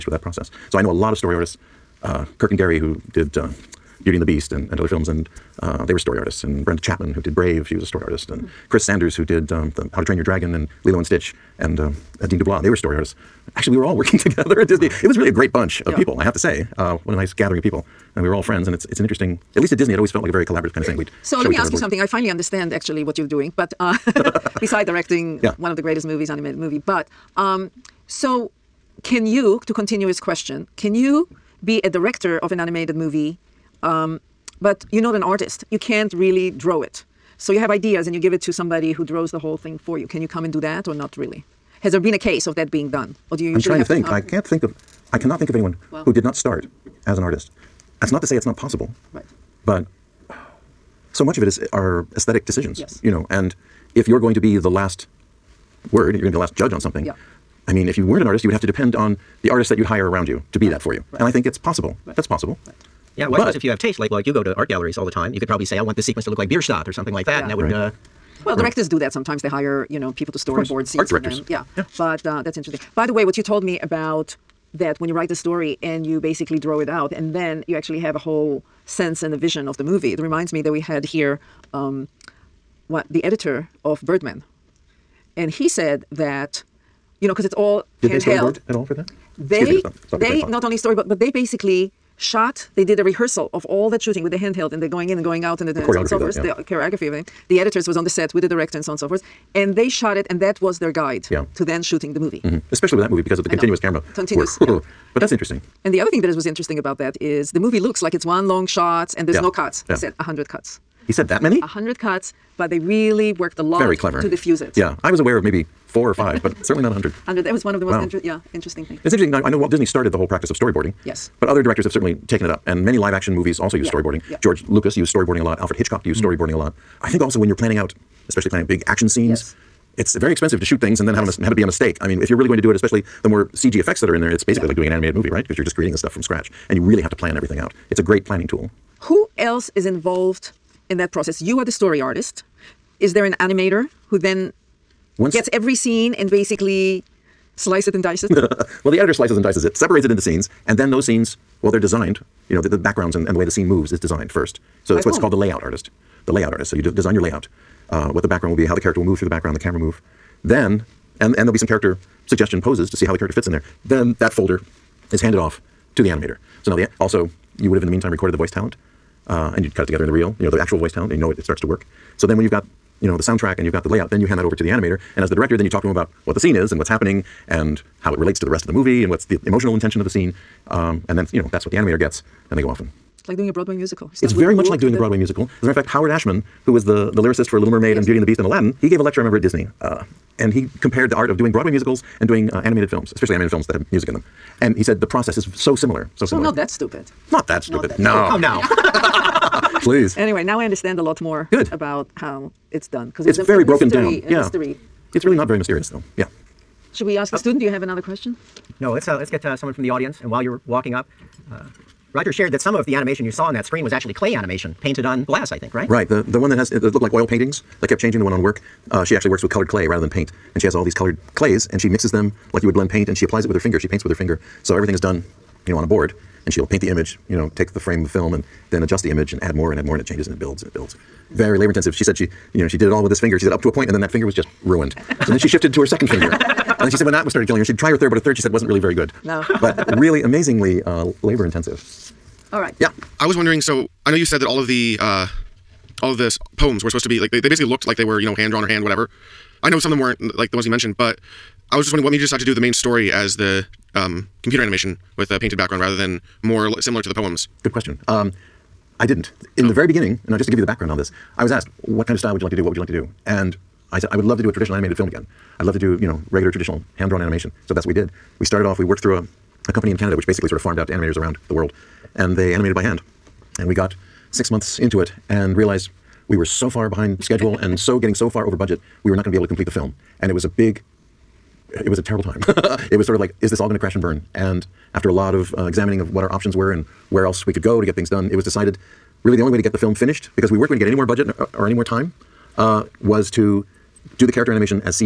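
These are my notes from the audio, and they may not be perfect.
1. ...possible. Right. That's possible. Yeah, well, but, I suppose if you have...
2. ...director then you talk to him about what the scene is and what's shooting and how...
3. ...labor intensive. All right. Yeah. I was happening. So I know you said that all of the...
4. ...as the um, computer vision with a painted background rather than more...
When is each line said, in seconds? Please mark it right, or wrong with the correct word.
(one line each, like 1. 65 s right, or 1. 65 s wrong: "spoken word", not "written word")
1. 61 s right
2. 175 s wrong: "happening", not "shooting"
3. 241 s wrong: "wondering", not "happening"
4. 253 s wrong: "animation", not "vision".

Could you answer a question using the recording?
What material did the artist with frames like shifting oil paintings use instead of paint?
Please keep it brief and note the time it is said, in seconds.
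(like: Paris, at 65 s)
colored clay, at 219 s.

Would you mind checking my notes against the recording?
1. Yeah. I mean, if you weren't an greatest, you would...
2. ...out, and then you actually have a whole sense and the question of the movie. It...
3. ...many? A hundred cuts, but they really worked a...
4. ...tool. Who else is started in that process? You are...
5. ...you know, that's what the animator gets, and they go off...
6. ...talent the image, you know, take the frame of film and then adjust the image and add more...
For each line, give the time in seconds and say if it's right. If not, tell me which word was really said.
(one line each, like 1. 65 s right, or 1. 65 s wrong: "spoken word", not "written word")
1. 57 s wrong: "artist", not "greatest"
2. 76 s wrong: "vision", not "question"
3. 111 s right
4. 138 s wrong: "involved", not "started"
5. 181 s right
6. 226 s wrong: "paint", not "talent".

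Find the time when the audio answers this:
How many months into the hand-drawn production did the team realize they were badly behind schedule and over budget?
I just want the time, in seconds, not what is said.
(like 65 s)
274 s.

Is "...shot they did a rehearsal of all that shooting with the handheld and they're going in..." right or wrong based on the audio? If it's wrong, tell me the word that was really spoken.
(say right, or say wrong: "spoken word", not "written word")
right.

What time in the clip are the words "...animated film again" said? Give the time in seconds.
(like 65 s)
264 s.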